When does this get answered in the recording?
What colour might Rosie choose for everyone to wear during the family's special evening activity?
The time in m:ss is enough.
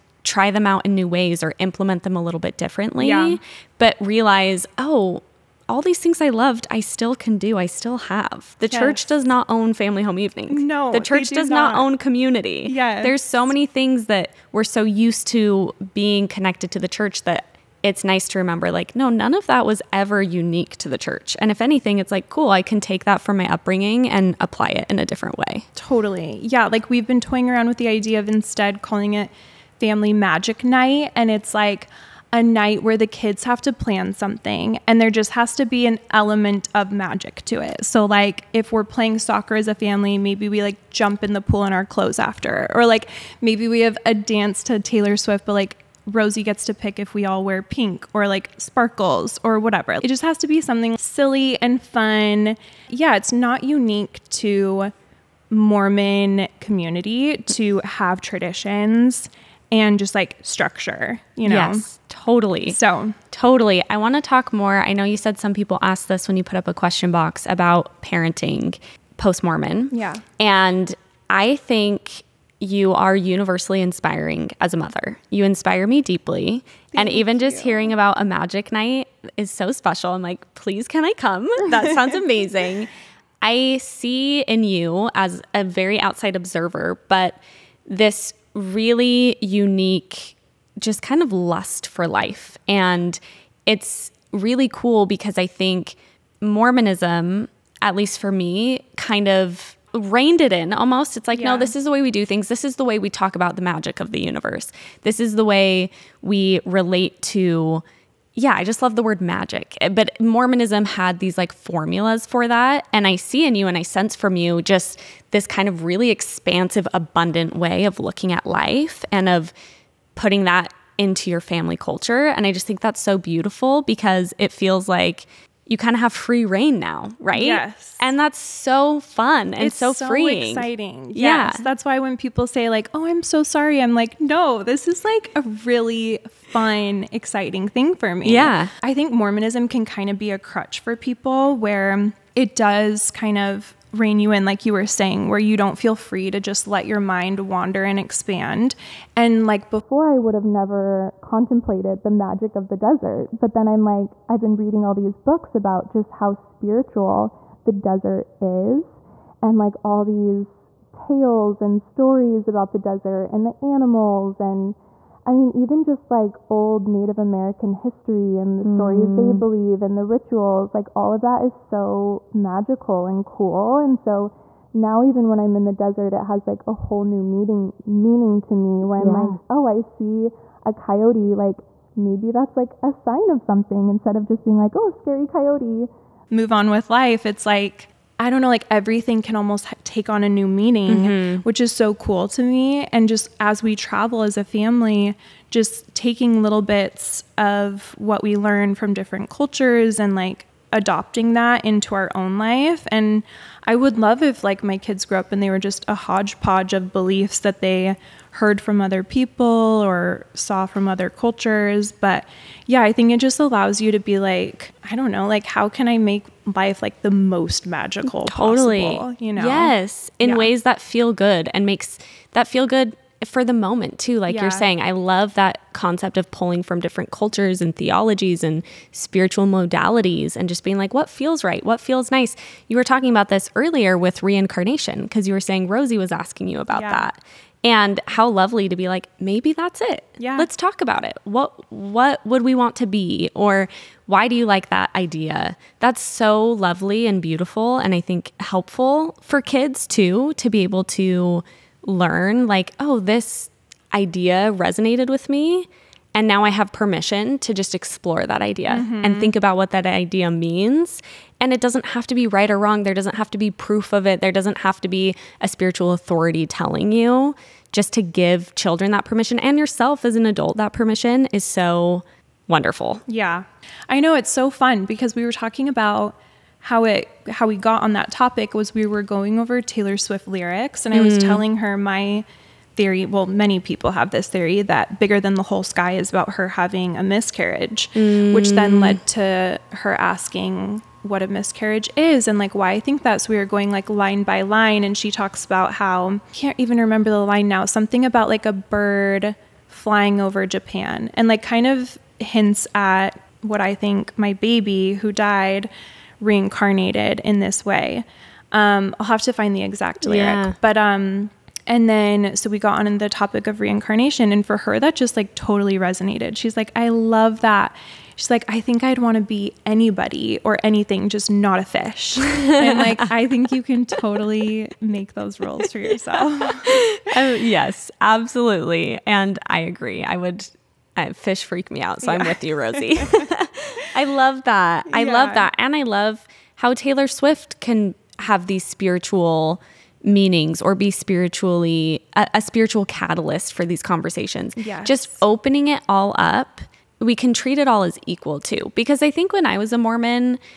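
0:47.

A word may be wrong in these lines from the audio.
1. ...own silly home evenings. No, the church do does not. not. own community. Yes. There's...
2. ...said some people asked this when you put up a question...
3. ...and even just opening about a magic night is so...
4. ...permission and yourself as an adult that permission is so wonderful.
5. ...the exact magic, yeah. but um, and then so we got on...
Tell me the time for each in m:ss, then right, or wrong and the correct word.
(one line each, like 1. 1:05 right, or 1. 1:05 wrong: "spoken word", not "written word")
1. 0:09 wrong: "family", not "silly"
2. 1:05 right
3. 1:17 wrong: "hearing", not "opening"
4. 4:29 right
5. 5:09 wrong: "lyric", not "magic".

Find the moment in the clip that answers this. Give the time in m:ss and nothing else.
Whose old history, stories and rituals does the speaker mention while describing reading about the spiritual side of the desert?
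2:46.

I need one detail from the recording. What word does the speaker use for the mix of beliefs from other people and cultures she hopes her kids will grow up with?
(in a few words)
hodgepodge.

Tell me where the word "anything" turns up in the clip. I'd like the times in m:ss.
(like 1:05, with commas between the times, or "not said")
0:21, 5:20.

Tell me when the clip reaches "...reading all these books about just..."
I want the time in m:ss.
2:34.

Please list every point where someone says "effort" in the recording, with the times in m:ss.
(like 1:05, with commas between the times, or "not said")
not said.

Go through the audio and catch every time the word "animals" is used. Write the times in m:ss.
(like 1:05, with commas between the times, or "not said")
2:43.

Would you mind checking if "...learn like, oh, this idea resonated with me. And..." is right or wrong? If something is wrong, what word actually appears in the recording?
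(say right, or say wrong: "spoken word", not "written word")
right.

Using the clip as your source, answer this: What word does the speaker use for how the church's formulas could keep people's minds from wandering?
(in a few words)
crutch.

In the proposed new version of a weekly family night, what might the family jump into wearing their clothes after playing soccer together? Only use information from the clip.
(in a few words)
the pool.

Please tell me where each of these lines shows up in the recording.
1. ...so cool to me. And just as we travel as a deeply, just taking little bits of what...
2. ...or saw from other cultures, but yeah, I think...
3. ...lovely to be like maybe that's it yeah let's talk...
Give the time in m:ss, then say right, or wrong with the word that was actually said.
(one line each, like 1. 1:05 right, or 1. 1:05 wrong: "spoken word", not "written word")
1. 3:11 wrong: "family", not "deeply"
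2. 3:29 right
3. 3:58 right.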